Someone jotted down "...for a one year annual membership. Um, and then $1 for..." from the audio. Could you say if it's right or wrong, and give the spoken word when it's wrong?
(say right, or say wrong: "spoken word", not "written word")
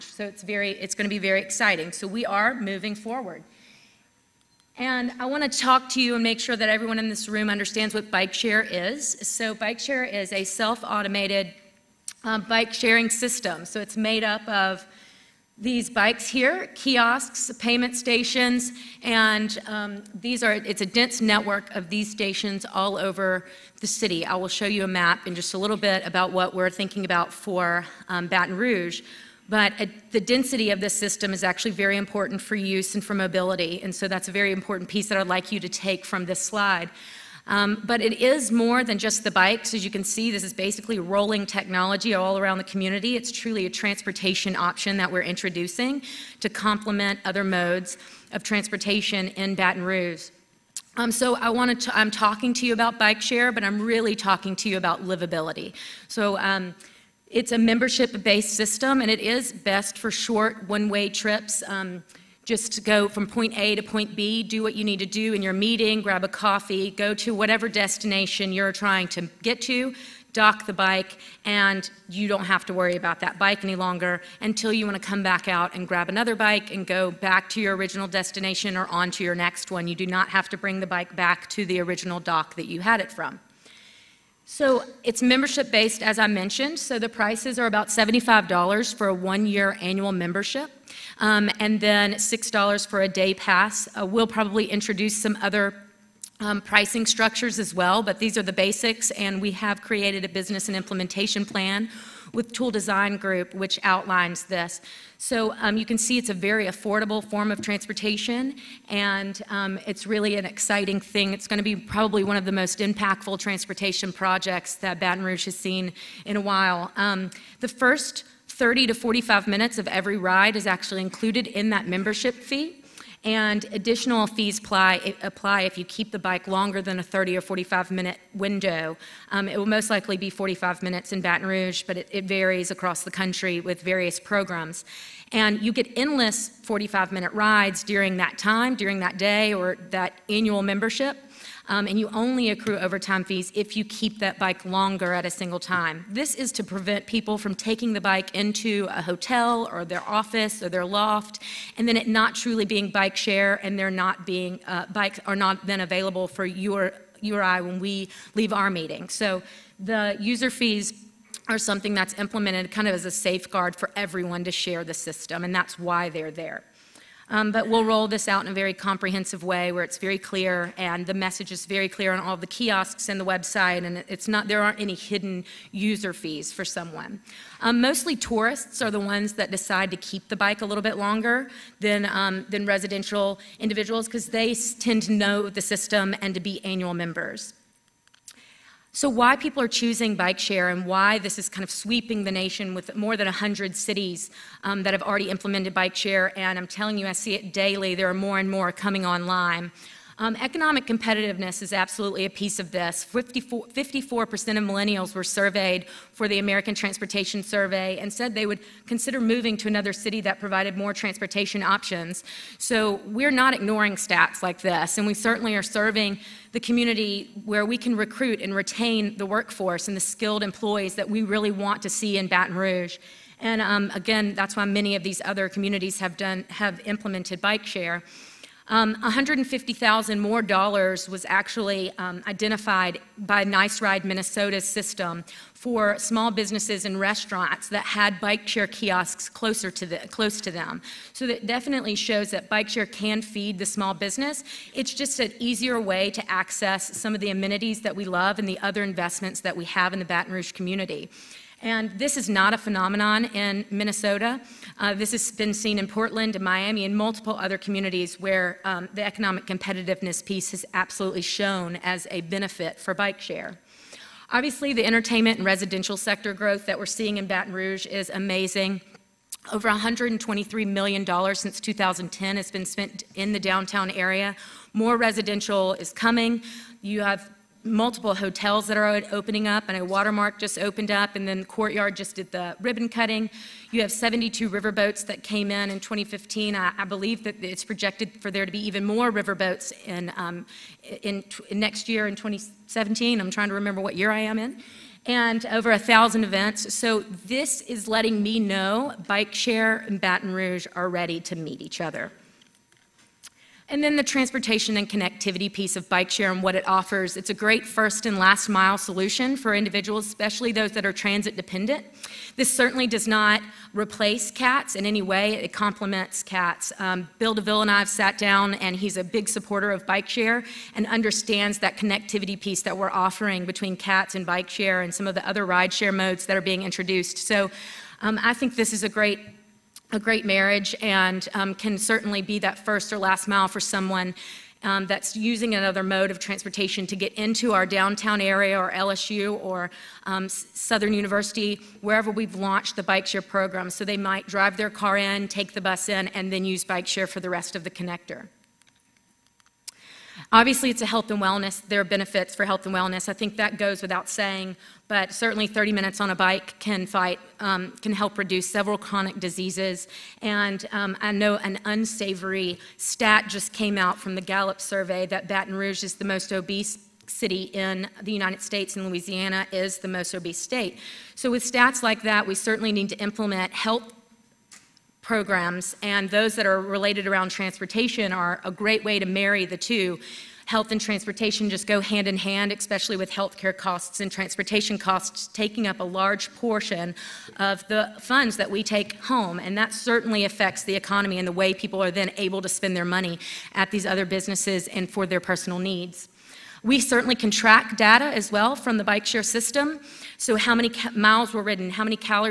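wrong: "6", not "1".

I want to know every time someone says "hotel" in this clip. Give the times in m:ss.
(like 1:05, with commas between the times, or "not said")
2:29, 4:38.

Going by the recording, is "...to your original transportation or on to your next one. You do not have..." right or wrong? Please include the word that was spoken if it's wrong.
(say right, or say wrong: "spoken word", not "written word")
wrong: "destination", not "transportation".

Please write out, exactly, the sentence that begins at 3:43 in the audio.
And um, again, that's why many of these other communities have done have implemented bike share.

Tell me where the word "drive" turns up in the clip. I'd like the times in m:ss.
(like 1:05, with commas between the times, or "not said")
5:44.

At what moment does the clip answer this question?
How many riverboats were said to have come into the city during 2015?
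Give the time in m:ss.
4:43.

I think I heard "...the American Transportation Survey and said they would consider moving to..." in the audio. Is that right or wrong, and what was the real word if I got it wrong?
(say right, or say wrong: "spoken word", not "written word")
right.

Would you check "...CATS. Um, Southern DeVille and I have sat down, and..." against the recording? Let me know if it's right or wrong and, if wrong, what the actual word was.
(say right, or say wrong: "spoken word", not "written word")
wrong: "Bill", not "Southern".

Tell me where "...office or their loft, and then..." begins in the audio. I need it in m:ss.
2:30.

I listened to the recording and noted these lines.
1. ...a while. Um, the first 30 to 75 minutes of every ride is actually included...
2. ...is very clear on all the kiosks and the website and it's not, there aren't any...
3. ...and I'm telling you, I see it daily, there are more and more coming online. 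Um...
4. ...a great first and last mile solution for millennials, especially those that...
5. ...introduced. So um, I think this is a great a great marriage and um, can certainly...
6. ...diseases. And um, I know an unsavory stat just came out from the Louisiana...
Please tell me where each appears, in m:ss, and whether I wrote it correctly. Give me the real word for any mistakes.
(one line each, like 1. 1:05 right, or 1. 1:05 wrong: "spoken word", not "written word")
1. 1:56 wrong: "45", not "75"
2. 2:51 right
3. 3:16 right
4. 5:07 wrong: "individuals", not "millennials"
5. 5:26 right
6. 5:59 wrong: "Gallup", not "Louisiana".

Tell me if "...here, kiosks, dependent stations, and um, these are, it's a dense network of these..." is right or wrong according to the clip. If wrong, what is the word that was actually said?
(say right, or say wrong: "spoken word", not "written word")
wrong: "payment", not "dependent".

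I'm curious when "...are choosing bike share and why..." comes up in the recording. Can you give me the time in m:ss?
3:09.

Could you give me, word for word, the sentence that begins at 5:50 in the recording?
Obviously, it's a health and wellness.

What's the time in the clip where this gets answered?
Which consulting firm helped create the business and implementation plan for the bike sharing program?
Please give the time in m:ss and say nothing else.
1:42.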